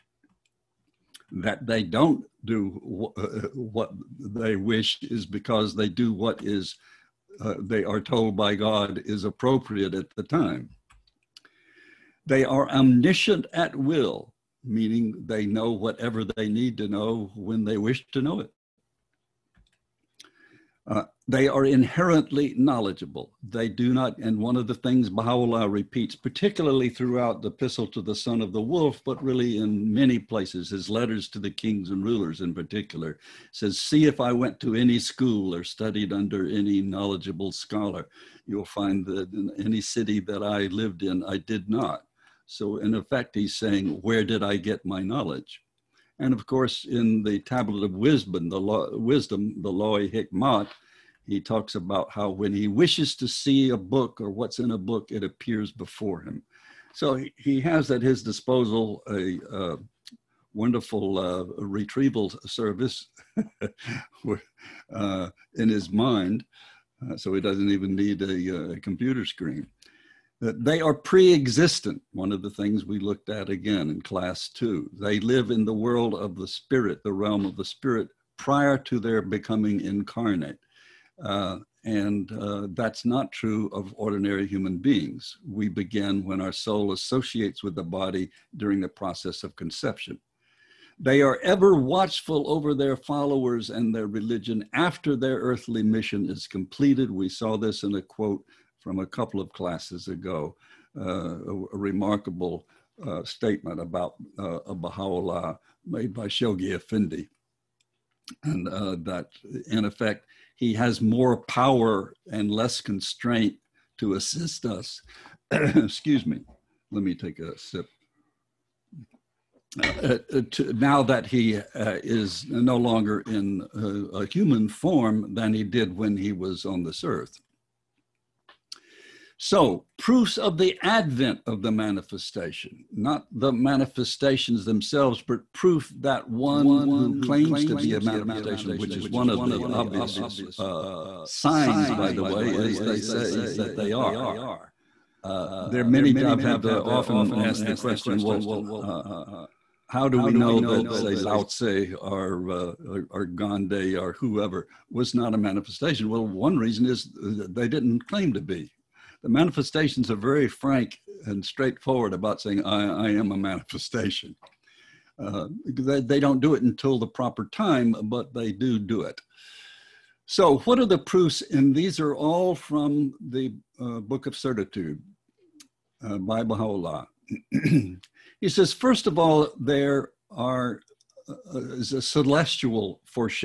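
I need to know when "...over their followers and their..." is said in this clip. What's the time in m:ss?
1:32.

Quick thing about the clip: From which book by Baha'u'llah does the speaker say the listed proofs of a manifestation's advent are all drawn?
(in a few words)
Book of Certitude.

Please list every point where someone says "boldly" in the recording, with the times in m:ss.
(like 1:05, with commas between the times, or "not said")
not said.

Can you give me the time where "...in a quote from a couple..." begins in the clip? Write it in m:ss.
1:37.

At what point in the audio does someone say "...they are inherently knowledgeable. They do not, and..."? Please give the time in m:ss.
0:21.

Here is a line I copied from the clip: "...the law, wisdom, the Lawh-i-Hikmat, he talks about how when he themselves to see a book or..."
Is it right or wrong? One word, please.
wrong.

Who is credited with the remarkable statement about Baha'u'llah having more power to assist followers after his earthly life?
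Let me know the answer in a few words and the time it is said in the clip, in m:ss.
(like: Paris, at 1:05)
Shoghi Effendi, at 1:46.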